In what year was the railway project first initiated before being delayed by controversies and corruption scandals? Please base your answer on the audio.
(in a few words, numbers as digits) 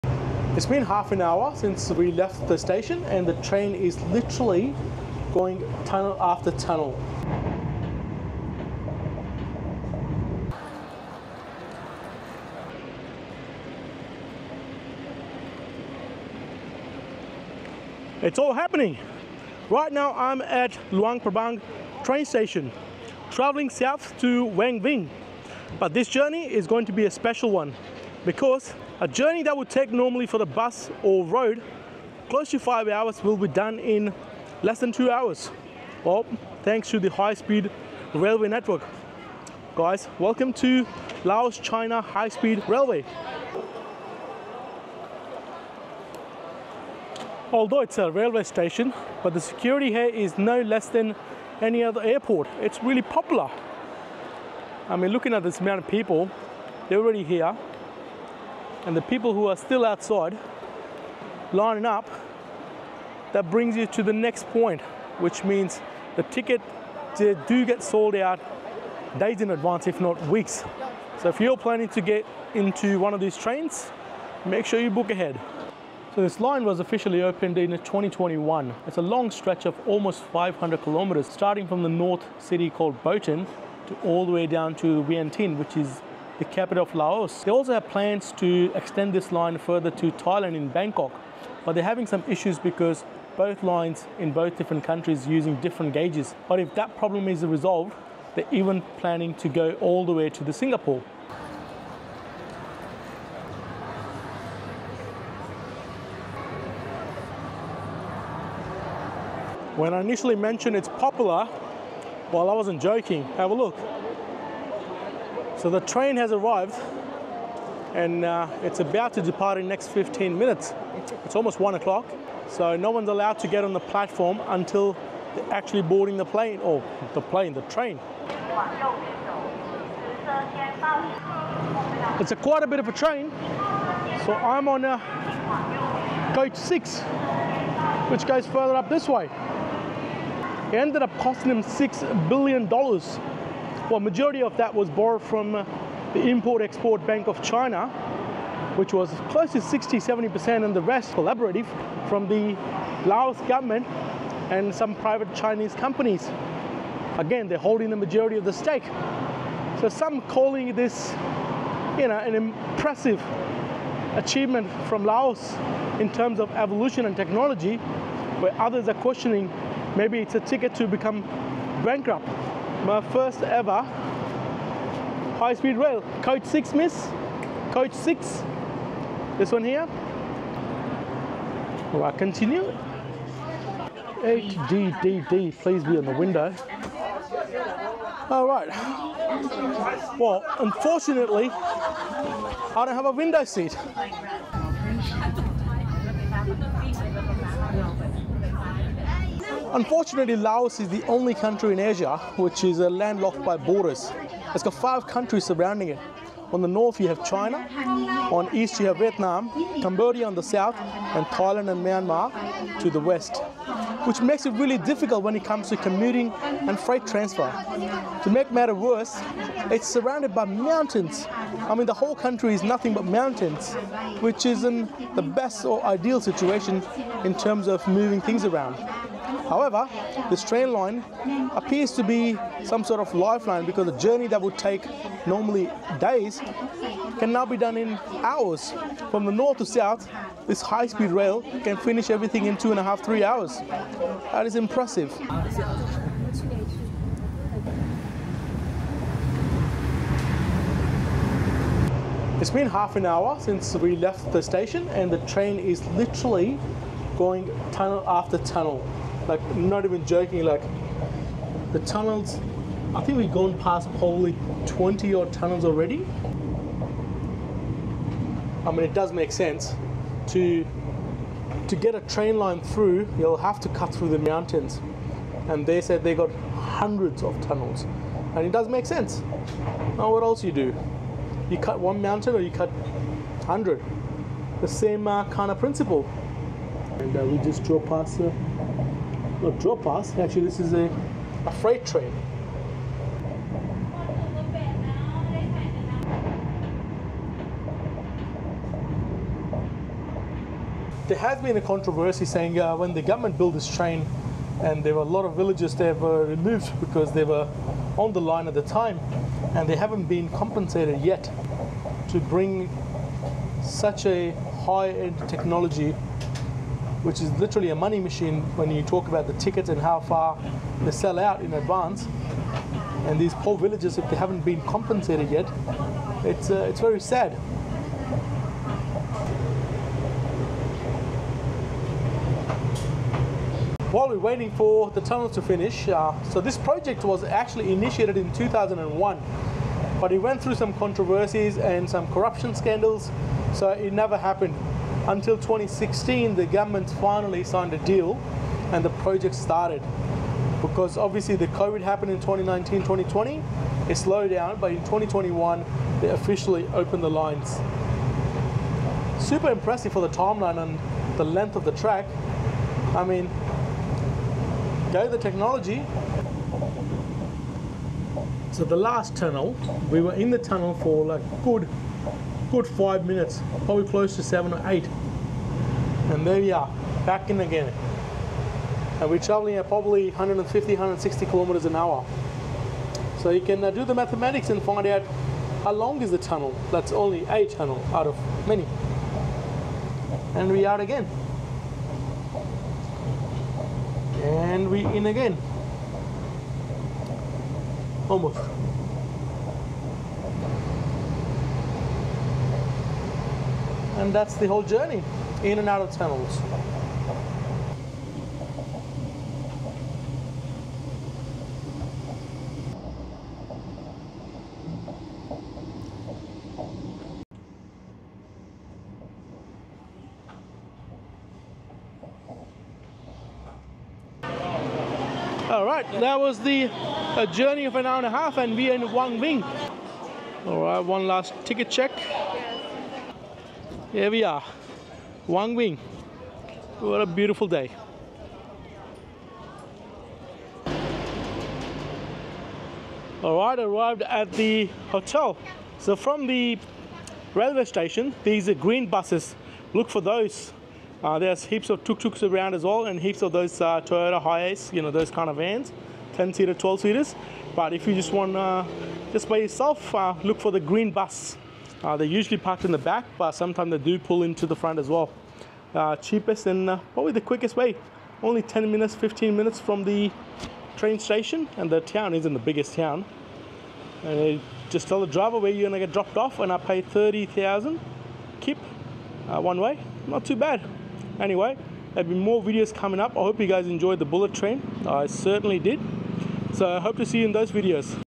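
2001.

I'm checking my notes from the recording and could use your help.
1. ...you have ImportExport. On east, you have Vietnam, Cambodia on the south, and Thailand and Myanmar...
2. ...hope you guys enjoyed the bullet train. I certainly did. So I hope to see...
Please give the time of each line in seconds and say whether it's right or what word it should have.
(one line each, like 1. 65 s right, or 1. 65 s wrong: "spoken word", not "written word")
1. 206 s wrong: "China", not "ImportExport"
2. 483 s right.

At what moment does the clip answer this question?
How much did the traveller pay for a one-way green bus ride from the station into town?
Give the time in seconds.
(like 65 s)
476 s.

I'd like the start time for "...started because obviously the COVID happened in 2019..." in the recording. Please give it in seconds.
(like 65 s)
349 s.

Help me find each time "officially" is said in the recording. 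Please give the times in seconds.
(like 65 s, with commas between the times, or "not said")
76 s, 356 s.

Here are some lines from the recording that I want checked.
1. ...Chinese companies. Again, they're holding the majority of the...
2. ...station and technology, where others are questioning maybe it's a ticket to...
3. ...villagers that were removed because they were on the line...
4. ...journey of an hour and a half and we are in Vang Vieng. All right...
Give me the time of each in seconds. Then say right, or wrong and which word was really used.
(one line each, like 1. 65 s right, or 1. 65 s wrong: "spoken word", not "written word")
1. 155 s right
2. 166 s wrong: "evolution", not "station"
3. 305 s right
4. 427 s right.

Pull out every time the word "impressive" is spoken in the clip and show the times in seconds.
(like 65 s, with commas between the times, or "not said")
162 s, 244 s, 359 s.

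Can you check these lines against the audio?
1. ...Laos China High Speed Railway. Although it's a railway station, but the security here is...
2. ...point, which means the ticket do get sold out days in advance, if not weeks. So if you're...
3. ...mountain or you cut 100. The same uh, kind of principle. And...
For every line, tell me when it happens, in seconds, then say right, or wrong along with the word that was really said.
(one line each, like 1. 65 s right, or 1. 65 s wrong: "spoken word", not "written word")
1. 41 s right
2. 64 s right
3. 282 s right.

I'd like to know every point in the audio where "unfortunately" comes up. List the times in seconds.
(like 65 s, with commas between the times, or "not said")
190 s, 199 s.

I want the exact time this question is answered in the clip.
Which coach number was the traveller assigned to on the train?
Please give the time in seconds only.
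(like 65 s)
136 s.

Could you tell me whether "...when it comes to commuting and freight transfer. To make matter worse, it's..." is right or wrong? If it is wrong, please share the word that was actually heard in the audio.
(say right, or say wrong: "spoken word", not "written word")
right.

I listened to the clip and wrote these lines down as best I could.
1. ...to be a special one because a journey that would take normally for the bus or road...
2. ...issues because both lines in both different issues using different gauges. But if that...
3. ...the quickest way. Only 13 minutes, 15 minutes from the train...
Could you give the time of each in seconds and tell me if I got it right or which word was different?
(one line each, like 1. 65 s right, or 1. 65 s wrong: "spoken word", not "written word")
1. 26 s right
2. 92 s wrong: "countries", not "issues"
3. 467 s wrong: "10", not "13".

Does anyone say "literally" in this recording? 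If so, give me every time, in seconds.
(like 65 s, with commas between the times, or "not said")
4 s, 255 s, 317 s.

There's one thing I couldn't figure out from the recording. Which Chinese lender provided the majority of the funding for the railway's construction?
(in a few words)
Import-Export Bank of China.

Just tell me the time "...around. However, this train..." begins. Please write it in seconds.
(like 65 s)
228 s.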